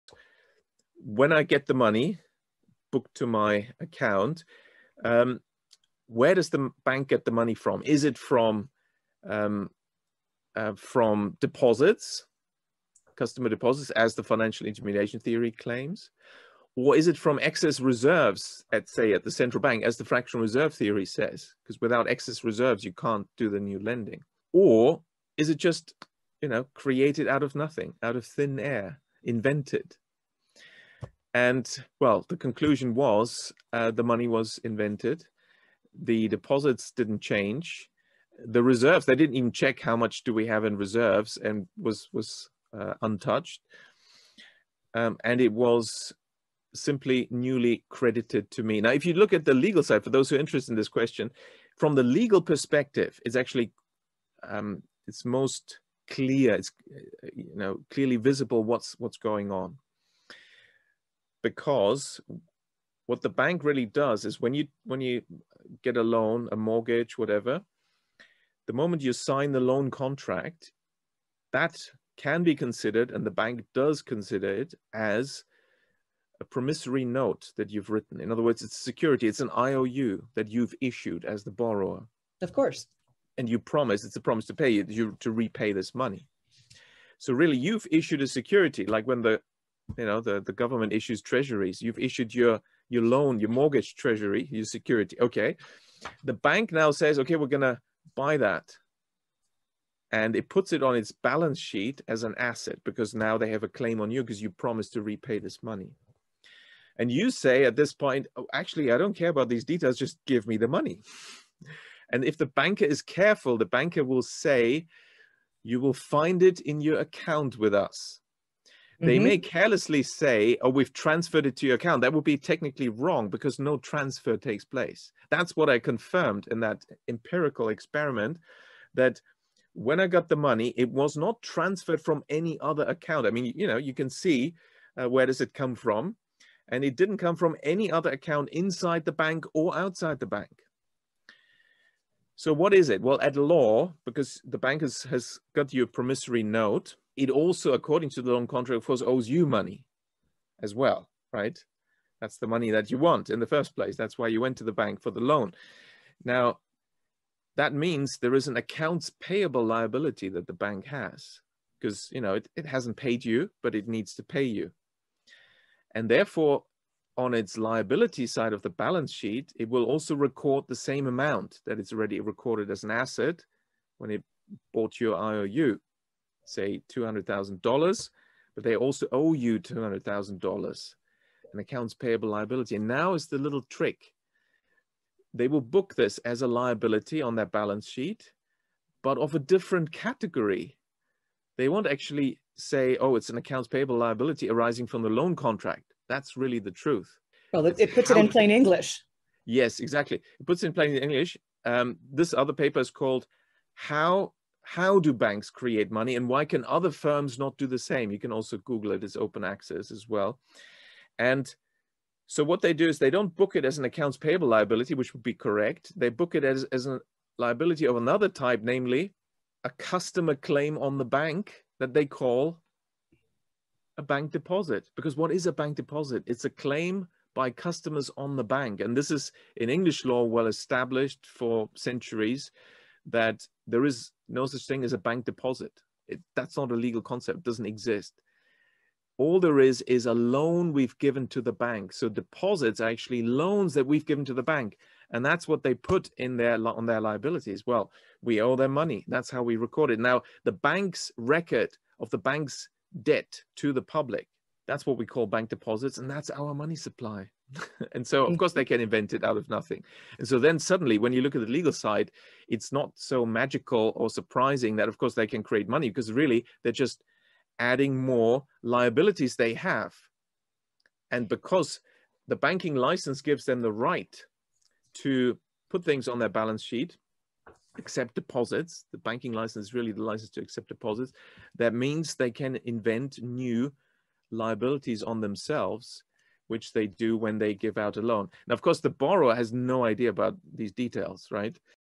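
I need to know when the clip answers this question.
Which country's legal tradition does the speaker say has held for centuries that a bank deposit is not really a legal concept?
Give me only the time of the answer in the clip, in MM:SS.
03:49.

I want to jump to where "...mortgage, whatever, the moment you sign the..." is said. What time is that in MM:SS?
01:06.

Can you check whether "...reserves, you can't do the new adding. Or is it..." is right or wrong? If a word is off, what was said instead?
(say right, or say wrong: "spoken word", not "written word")
wrong: "lending", not "adding".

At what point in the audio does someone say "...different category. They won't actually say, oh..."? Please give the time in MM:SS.
03:09.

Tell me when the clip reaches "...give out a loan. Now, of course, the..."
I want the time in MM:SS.
04:47.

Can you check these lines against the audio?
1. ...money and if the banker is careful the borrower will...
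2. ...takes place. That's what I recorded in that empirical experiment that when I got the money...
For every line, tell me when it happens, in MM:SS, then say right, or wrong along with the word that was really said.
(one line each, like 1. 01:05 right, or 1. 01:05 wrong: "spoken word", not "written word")
1. 01:50 wrong: "banker", not "borrower"
2. 02:04 wrong: "confirmed", not "recorded".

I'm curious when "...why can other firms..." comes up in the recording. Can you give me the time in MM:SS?
03:26.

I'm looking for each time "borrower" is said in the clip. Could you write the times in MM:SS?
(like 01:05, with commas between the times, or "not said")
01:21, 04:48.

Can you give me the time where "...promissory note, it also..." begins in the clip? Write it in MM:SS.
02:25.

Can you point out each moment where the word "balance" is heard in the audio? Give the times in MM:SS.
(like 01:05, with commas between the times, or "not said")
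01:41, 02:48, 03:07, 04:36.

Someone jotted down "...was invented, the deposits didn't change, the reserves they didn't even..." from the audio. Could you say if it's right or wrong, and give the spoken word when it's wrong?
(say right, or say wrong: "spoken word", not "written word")
right.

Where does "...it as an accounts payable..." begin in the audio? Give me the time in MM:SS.
03:33.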